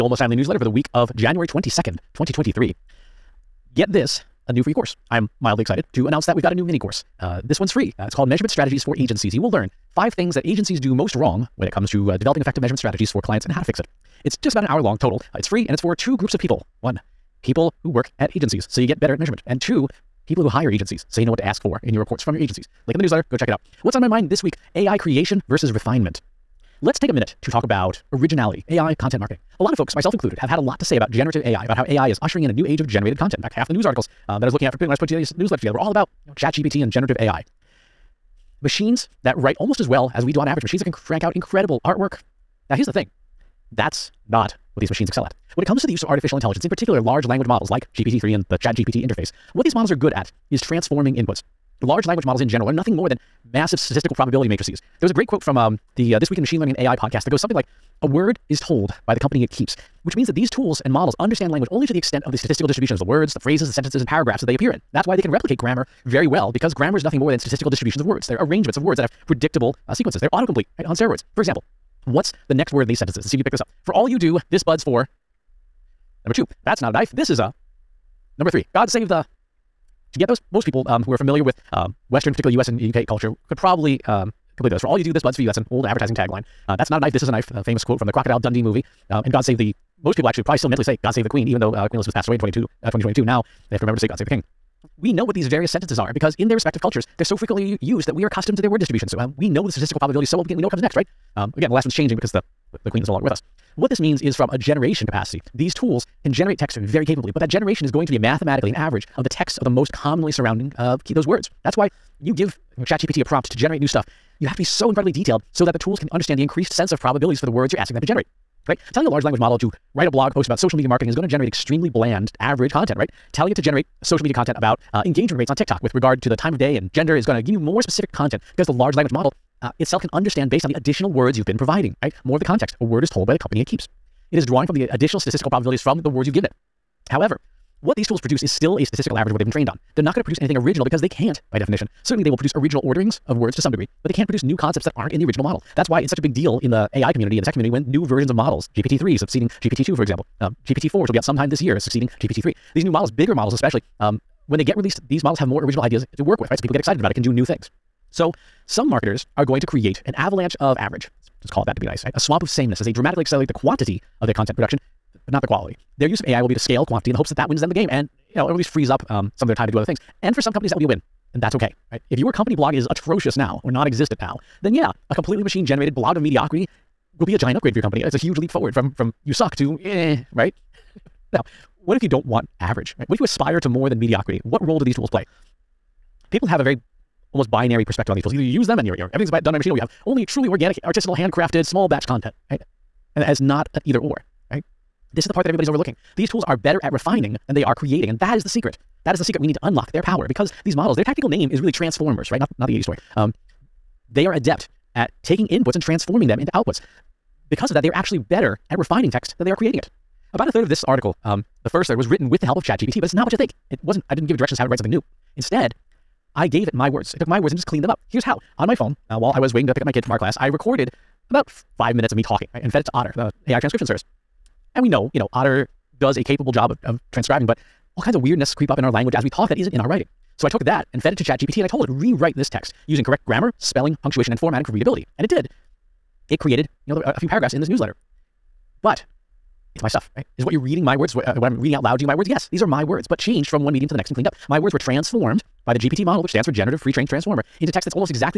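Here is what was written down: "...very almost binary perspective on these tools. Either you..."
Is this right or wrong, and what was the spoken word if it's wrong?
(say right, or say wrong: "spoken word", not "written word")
right.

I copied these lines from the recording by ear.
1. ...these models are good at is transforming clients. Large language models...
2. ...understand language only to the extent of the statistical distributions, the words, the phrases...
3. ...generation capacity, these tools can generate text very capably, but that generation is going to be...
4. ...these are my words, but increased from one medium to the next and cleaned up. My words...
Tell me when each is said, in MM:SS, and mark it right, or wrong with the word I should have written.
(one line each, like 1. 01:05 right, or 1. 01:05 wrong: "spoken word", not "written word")
1. 00:49 wrong: "inputs", not "clients"
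2. 01:01 right
3. 01:44 right
4. 04:02 wrong: "changed", not "increased".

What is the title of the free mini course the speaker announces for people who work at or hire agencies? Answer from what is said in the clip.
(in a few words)
Measurement Strategies for Agencies.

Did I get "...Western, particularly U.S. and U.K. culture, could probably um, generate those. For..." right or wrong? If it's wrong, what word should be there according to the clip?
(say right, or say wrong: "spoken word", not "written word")
wrong: "complete", not "generate".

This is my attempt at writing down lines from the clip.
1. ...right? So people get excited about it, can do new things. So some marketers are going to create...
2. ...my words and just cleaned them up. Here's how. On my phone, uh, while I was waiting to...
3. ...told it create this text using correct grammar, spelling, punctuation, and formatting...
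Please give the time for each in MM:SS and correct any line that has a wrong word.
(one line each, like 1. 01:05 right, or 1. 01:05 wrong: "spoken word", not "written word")
1. 02:36 right
2. 03:37 right
3. 03:51 wrong: "rewrite", not "create".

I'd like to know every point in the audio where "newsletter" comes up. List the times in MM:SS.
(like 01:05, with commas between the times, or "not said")
00:00, 00:23, 00:35, 03:57.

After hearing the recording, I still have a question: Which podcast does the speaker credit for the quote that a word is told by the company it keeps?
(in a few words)
This Week in Machine Learning and AI.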